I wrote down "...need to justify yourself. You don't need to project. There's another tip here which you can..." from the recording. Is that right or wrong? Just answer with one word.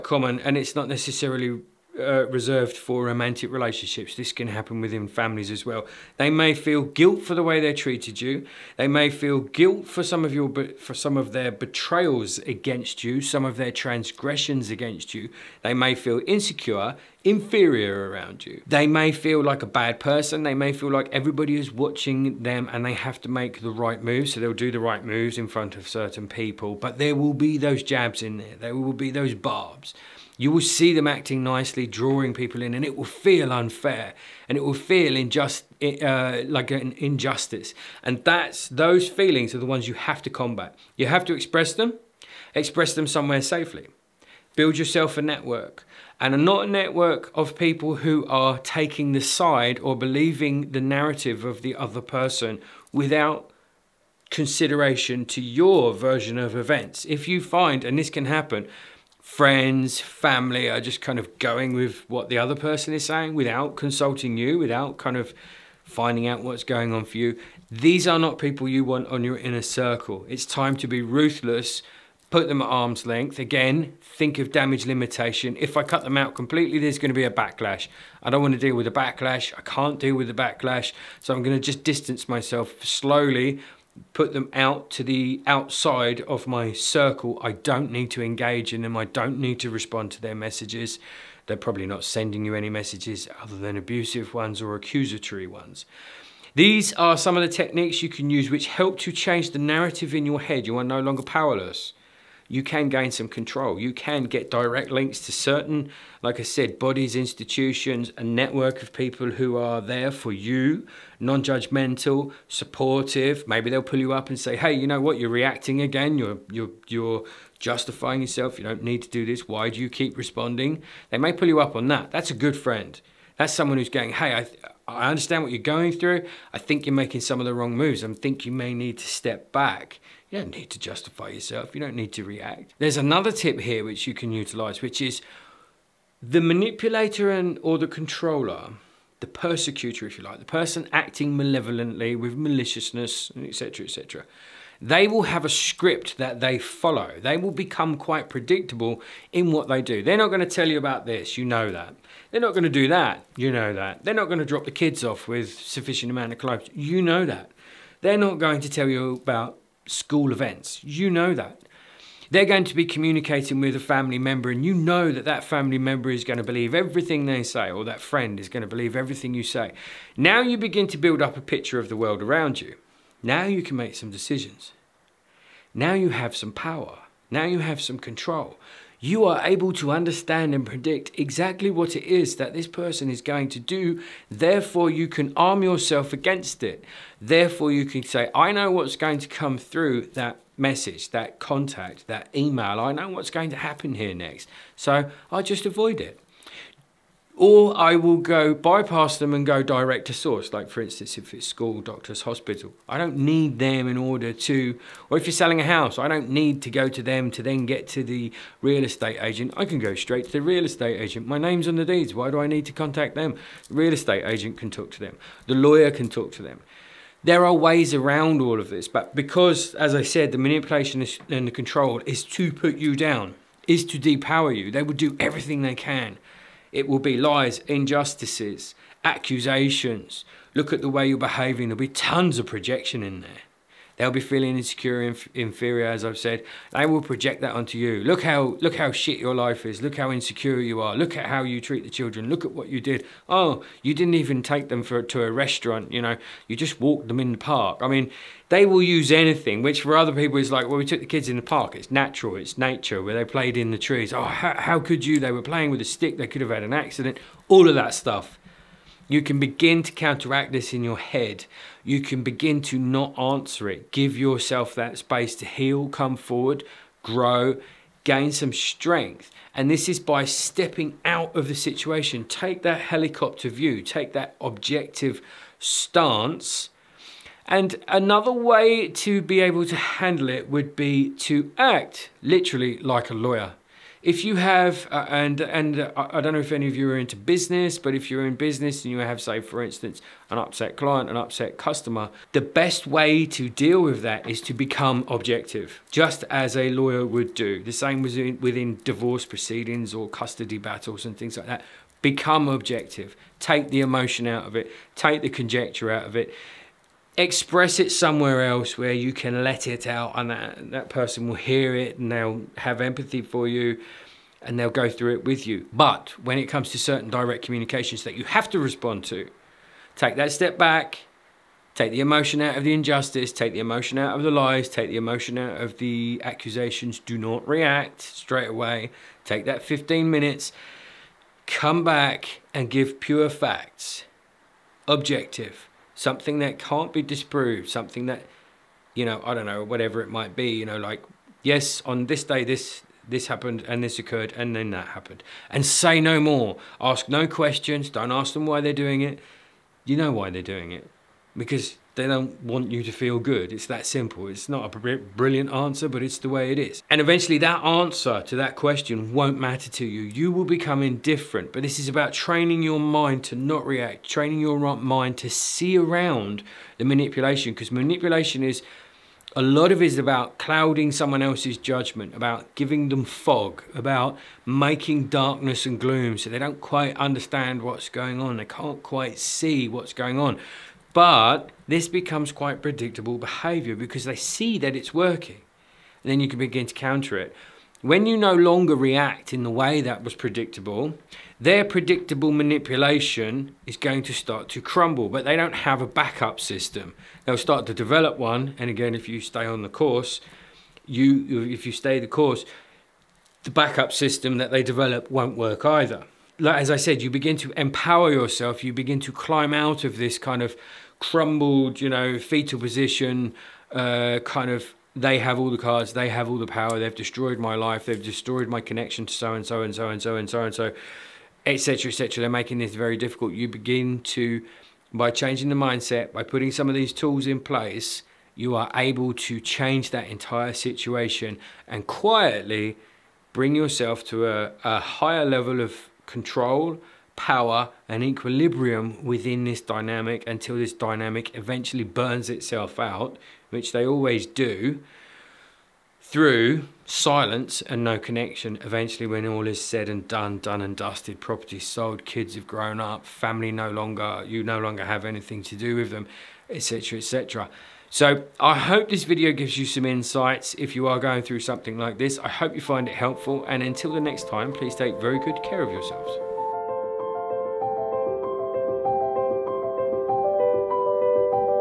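wrong.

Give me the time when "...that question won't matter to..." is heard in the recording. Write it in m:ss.
5:58.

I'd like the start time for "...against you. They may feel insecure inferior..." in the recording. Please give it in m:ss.
0:14.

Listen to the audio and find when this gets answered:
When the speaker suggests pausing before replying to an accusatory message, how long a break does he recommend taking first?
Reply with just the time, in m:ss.
5:29.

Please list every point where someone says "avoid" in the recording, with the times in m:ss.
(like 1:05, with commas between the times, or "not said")
3:15.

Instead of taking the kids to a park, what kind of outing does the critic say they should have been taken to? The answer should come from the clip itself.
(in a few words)
A restaurant.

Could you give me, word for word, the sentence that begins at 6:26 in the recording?
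And then you can begin to counter it.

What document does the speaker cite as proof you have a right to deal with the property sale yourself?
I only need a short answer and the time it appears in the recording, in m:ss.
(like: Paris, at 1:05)
The deeds, at 3:31.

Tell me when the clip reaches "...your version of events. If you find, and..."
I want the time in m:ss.
0:55.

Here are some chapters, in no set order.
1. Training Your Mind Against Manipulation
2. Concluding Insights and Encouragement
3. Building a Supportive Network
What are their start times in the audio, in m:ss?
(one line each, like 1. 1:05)
1. 6:03
2. 7:27
3. 2:05.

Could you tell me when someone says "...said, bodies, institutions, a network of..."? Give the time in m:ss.
1:46.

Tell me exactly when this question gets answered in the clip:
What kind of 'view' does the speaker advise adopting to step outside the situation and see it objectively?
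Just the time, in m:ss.
4:32.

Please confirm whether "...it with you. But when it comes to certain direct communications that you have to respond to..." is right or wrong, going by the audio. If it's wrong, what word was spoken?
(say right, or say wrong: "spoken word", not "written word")
right.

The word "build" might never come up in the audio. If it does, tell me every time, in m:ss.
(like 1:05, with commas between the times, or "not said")
0:44, 2:50.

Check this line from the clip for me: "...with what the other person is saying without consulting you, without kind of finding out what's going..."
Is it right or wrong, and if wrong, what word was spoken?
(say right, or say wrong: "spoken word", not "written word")
right.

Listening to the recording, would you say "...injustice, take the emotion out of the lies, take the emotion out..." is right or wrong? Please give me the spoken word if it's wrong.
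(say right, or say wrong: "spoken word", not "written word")
right.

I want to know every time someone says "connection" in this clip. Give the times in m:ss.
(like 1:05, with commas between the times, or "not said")
6:58, 7:27.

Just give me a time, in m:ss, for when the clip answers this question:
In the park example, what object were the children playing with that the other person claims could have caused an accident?
4:15.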